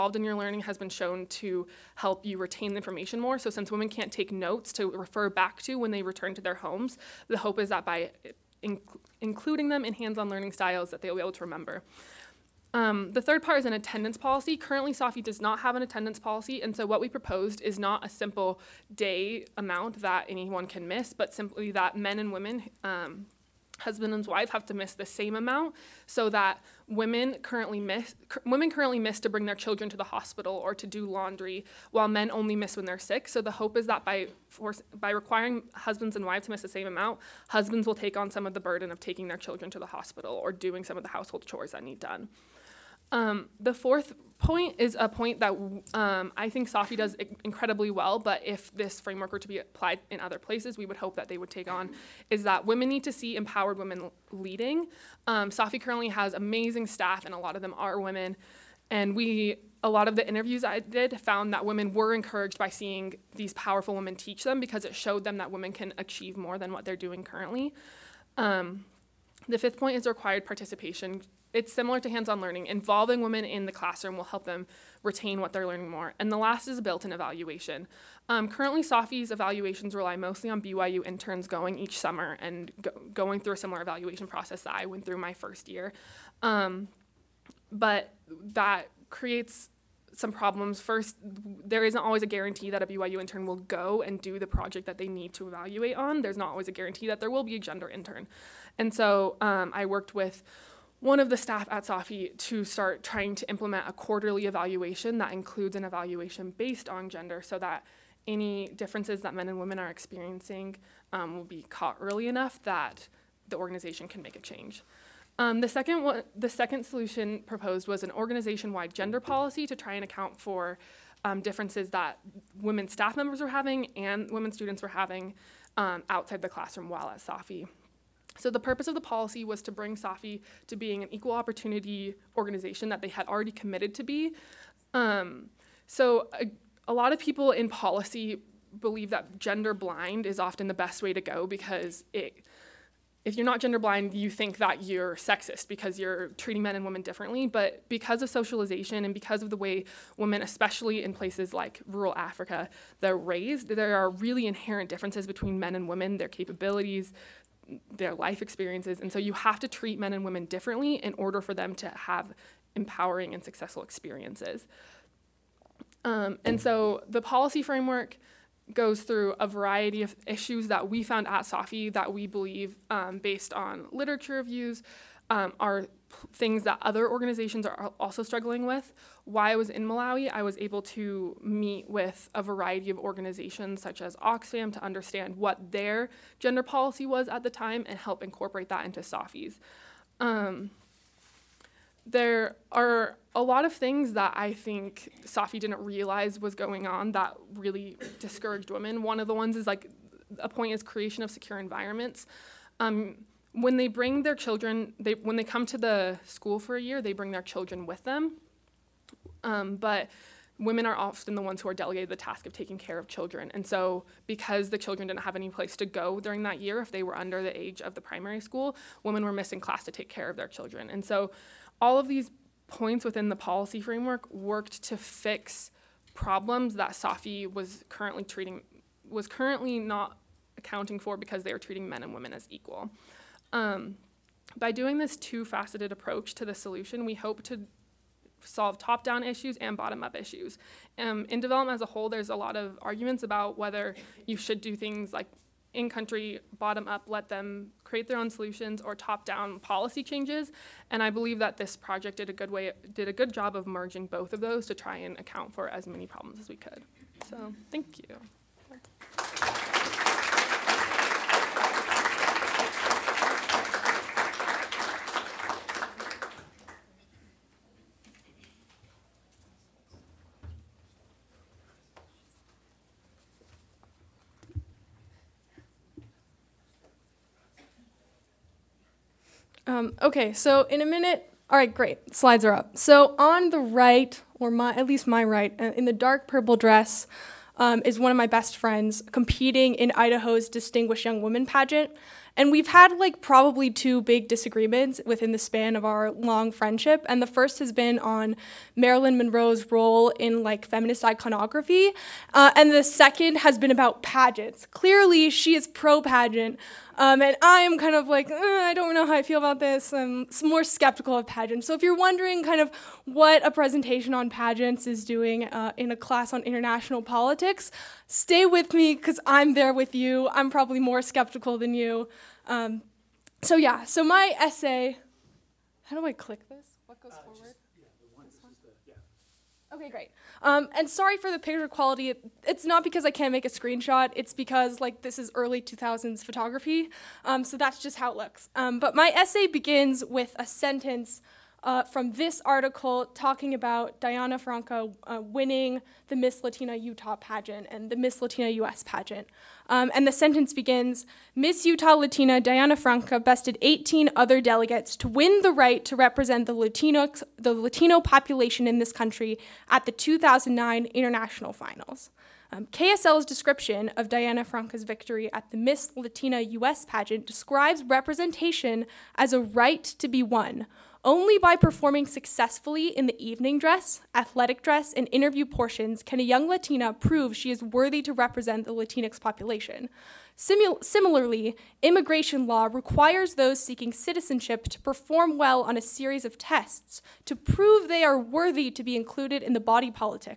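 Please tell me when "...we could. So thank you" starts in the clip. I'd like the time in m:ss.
4:16.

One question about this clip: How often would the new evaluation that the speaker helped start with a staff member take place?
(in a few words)
Quarterly.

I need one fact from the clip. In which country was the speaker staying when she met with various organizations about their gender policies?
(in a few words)
Malawi.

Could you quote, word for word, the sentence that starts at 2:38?
And so you have to treat men and women differently in order for them to have empowering and successful experiences.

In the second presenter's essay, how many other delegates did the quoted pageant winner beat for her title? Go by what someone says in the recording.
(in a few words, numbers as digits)
18.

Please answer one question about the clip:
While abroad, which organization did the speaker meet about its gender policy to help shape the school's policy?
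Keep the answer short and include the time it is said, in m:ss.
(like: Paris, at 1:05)
Oxfam, at 3:04.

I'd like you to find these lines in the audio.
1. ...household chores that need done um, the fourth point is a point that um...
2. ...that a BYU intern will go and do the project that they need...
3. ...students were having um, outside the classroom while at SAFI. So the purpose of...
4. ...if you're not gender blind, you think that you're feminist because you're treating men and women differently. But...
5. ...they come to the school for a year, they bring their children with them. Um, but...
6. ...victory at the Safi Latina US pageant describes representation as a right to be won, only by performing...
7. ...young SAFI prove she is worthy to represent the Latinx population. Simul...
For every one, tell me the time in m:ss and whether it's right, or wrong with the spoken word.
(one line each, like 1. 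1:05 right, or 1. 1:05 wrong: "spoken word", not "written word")
1. 0:41 right
2. 1:32 right
3. 2:04 right
4. 2:23 wrong: "sexist", not "feminist"
5. 3:25 right
6. 6:04 wrong: "Miss", not "Safi"
7. 6:16 wrong: "Latina", not "SAFI".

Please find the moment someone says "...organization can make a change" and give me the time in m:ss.
1:53.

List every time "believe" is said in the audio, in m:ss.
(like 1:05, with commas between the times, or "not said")
2:18, 2:52, 4:11.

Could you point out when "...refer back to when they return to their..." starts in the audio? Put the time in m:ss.
0:04.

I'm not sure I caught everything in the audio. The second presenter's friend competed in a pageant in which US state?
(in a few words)
Idaho.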